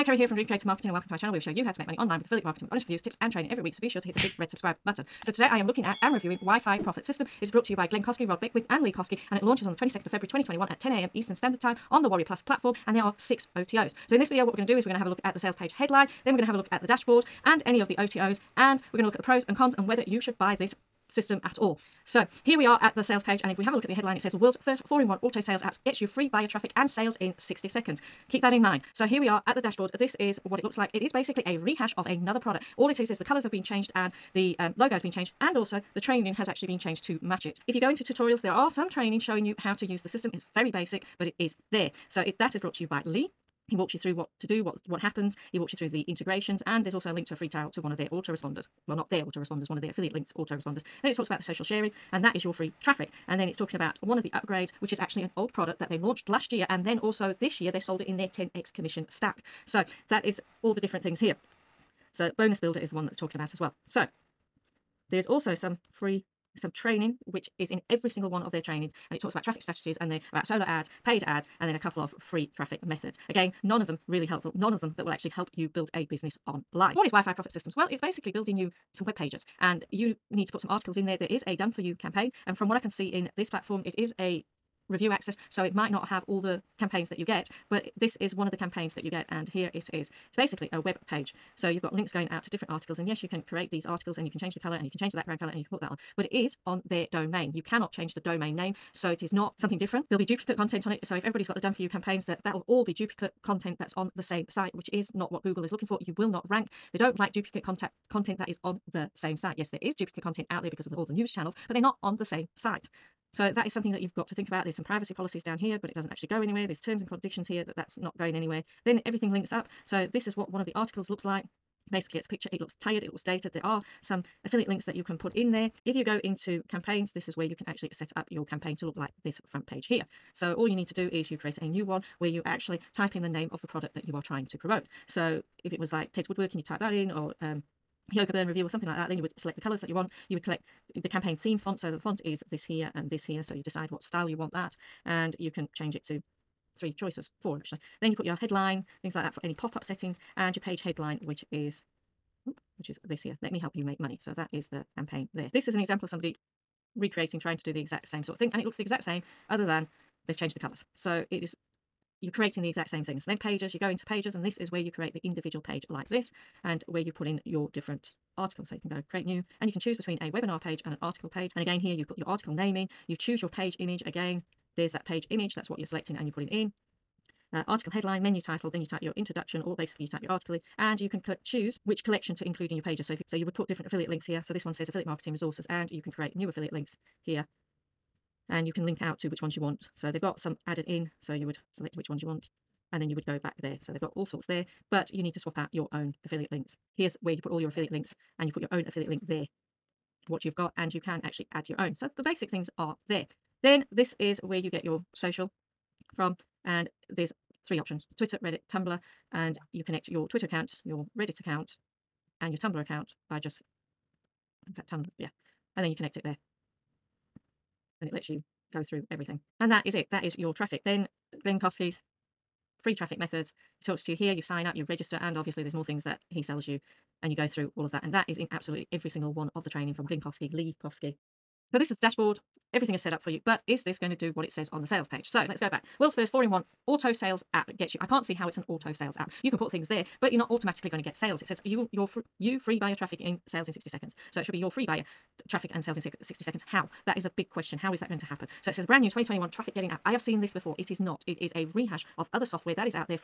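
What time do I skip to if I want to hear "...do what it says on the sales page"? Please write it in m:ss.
3:54.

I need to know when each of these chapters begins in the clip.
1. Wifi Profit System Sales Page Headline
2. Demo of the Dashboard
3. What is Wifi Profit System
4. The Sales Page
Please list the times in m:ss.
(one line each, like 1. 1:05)
1. 0:22
2. 0:30
3. 1:20
4. 4:02.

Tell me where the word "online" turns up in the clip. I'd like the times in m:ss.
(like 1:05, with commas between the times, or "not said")
0:01, 1:16.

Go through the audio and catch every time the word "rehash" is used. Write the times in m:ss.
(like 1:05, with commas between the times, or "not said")
0:31, 4:11.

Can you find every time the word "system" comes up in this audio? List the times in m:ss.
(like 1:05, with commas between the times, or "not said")
0:07, 0:21, 0:40, 1:17.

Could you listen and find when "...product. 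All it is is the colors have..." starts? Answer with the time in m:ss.
0:32.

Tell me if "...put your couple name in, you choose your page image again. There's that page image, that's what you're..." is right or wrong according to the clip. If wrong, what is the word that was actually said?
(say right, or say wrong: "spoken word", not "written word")
wrong: "article", not "couple".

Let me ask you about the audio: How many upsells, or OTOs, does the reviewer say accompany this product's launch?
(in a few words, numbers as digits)
6.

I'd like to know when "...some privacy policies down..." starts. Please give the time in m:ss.
1:54.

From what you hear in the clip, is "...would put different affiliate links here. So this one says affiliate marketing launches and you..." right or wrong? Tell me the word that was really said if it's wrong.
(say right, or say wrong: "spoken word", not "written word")
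wrong: "resources", not "launches".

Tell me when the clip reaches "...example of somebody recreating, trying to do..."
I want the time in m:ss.
2:35.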